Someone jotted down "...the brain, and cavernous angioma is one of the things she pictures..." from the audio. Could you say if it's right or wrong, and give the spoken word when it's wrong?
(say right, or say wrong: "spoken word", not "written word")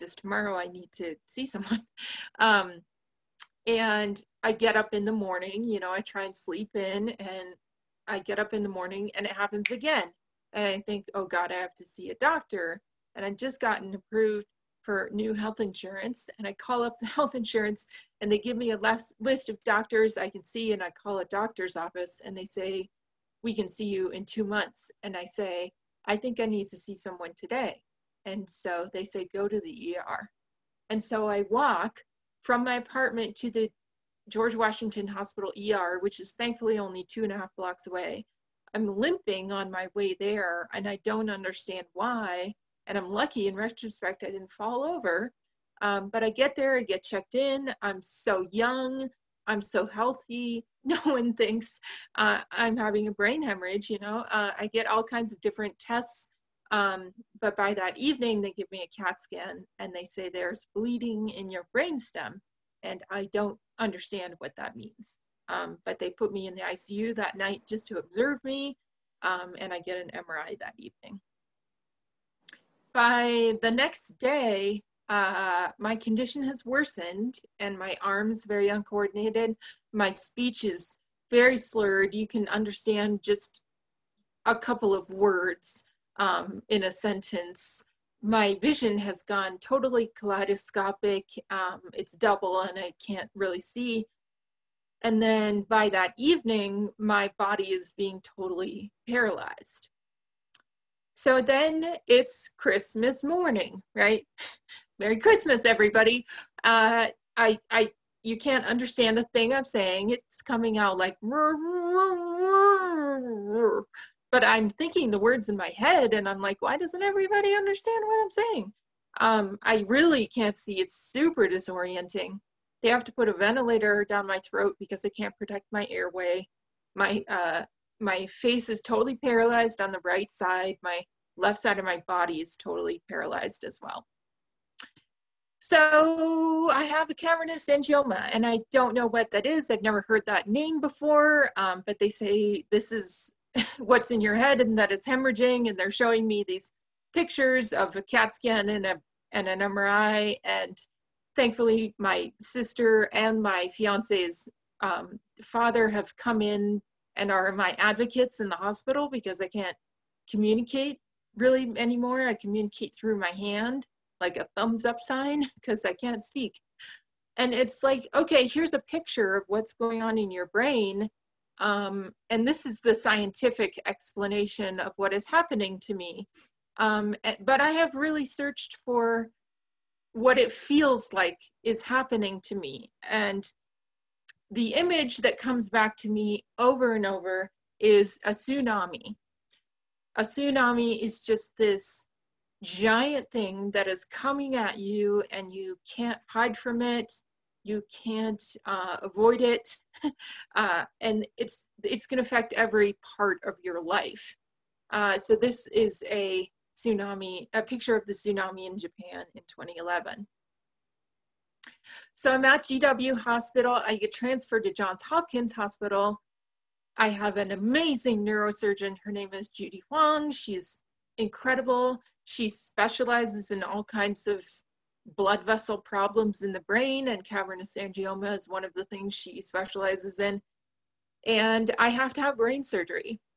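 wrong: "specializes", not "pictures".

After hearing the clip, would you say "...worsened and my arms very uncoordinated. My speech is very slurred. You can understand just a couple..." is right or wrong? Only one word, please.
right.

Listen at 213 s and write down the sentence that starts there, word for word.
I get transferred to Johns Hopkins Hospital.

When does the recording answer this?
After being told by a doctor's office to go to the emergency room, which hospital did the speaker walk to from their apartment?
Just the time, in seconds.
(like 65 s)
34 s.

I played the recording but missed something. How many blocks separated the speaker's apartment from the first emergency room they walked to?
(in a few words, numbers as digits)
2 and a half blocks.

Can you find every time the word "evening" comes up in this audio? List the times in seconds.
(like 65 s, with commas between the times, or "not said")
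57 s, 70 s, 96 s.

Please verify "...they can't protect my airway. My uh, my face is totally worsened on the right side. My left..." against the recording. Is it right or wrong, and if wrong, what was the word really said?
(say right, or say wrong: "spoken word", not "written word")
wrong: "paralyzed", not "worsened".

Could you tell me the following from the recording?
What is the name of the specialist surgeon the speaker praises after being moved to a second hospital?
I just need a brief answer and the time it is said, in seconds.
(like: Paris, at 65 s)
Judy Huang, at 219 s.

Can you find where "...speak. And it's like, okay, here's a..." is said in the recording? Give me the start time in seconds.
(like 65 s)
166 s.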